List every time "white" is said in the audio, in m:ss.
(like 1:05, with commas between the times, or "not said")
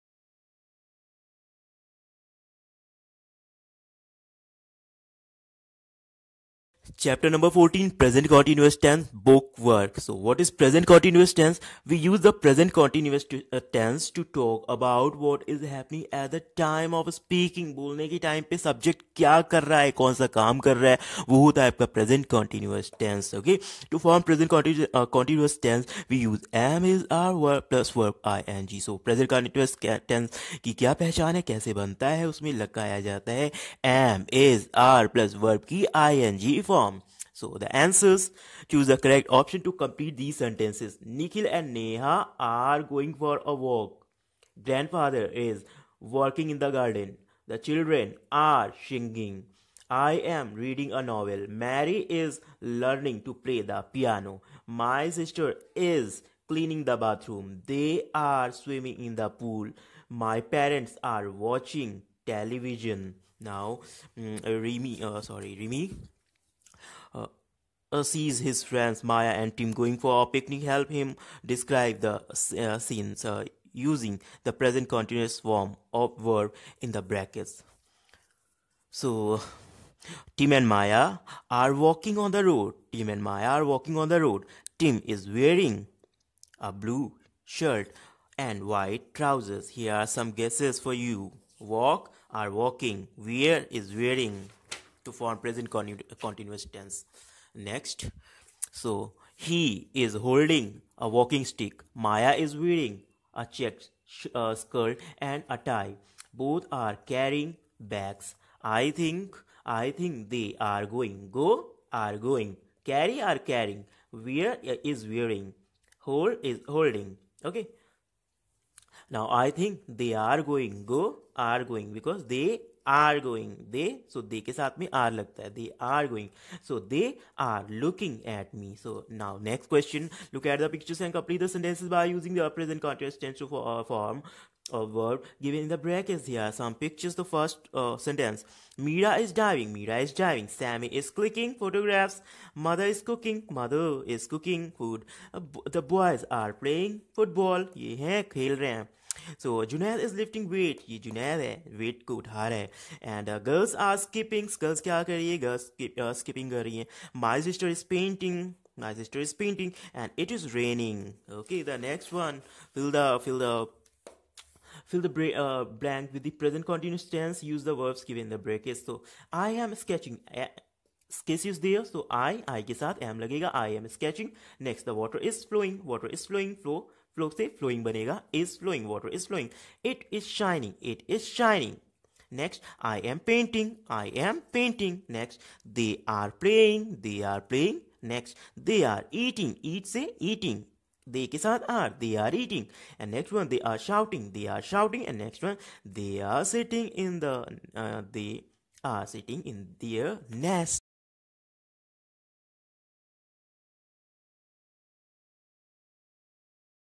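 1:28.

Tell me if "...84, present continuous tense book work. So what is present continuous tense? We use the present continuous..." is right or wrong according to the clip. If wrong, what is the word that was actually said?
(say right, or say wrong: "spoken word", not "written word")
wrong: "14", not "84".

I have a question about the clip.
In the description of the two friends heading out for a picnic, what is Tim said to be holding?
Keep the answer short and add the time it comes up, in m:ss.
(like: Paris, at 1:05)
a walking stick, at 1:41.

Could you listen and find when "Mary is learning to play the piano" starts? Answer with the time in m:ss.
0:51.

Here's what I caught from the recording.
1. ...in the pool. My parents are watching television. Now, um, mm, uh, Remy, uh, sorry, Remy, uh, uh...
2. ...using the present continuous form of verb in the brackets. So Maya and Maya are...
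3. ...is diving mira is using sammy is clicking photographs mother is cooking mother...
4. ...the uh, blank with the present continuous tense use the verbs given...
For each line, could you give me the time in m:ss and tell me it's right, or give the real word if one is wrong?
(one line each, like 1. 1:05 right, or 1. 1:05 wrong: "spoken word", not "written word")
1. 0:59 right
2. 1:13 wrong: "Tim", not "Maya"
3. 2:19 wrong: "diving", not "using"
4. 2:45 right.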